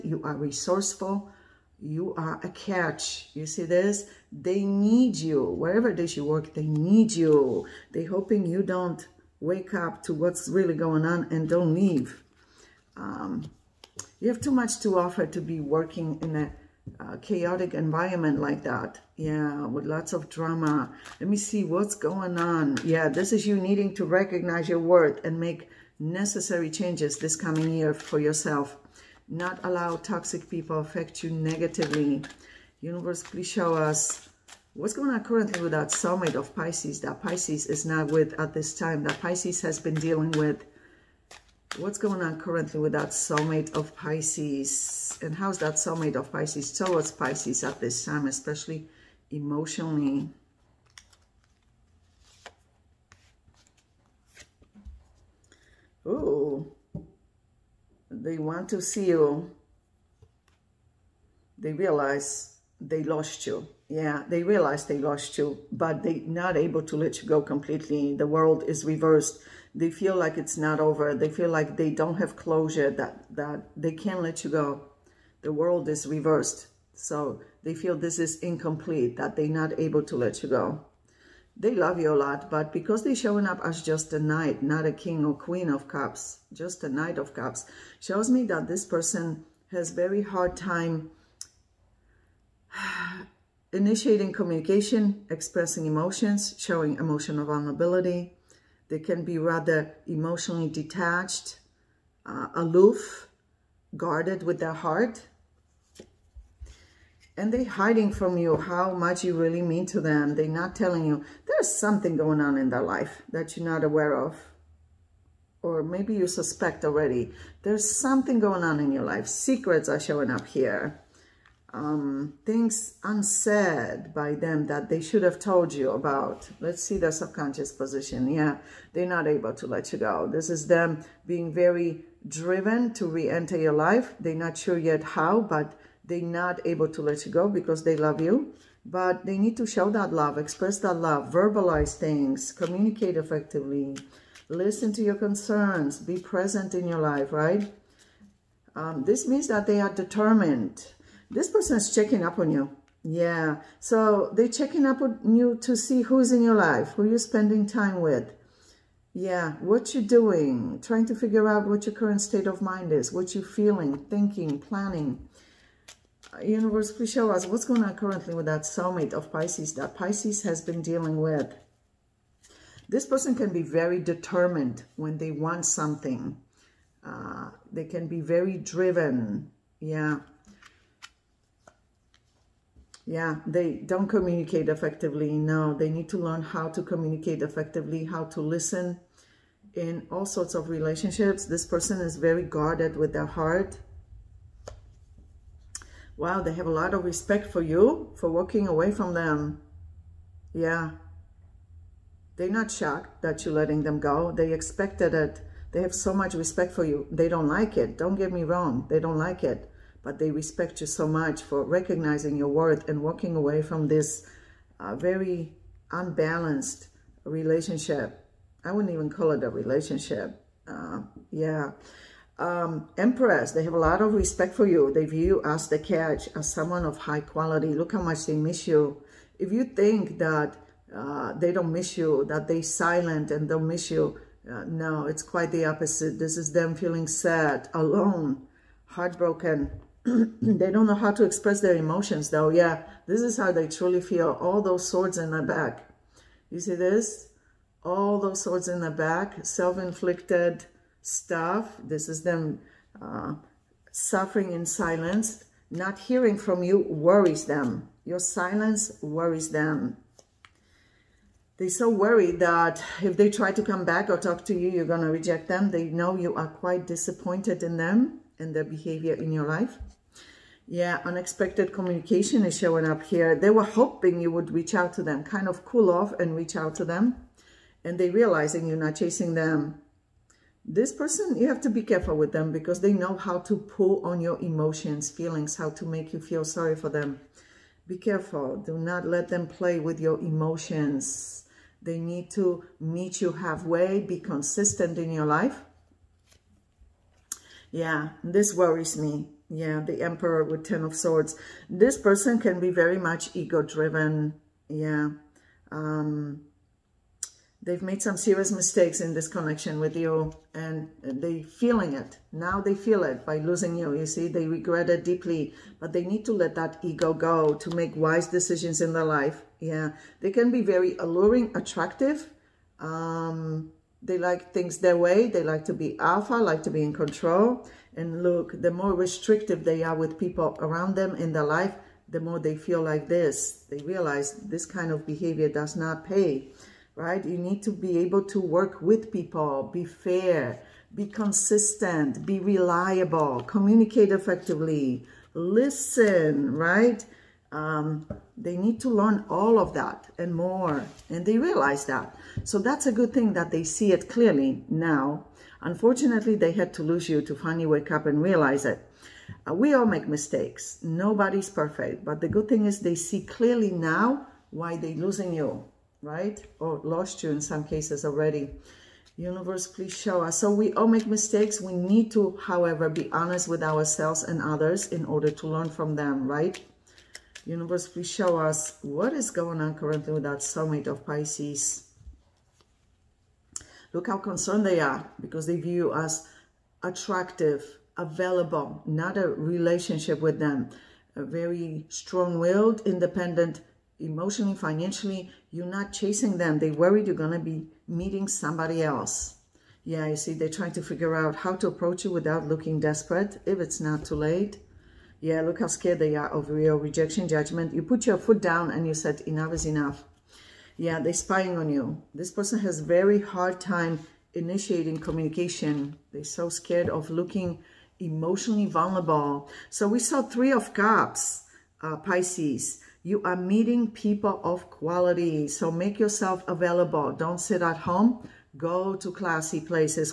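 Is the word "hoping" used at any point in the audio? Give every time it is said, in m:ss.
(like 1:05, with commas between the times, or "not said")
0:08, 4:33.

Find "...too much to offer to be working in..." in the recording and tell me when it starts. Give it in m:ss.
0:14.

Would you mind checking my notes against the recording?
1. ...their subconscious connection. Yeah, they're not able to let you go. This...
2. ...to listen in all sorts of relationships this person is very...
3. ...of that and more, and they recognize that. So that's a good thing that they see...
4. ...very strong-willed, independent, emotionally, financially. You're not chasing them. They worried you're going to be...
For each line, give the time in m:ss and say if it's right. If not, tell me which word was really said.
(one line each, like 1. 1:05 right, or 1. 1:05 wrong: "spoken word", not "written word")
1. 2:06 wrong: "position", not "connection"
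2. 3:08 right
3. 5:49 wrong: "realize", not "recognize"
4. 6:31 right.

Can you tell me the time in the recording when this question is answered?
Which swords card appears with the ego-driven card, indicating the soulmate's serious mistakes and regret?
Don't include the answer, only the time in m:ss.
5:00.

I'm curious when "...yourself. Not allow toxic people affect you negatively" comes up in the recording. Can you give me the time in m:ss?
0:28.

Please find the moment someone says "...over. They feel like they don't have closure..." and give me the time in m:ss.
1:10.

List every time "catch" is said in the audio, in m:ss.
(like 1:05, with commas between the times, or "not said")
0:02, 3:45.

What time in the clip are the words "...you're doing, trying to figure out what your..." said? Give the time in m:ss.
2:39.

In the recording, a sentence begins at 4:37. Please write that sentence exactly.
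And they realizing you're not chasing them.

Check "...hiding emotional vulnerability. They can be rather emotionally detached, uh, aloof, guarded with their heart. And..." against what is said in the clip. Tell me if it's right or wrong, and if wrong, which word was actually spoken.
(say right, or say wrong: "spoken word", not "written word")
wrong: "showing", not "hiding".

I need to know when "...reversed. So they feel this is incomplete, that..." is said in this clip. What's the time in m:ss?
1:16.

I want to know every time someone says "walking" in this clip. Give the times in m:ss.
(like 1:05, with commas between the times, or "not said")
3:18, 3:33.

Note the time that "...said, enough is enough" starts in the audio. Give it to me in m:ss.
6:48.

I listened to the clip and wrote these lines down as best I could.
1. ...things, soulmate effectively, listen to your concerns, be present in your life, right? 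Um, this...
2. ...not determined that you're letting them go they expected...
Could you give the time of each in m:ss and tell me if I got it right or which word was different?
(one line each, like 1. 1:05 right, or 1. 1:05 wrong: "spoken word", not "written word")
1. 2:21 wrong: "communicate", not "soulmate"
2. 3:22 wrong: "shocked", not "determined".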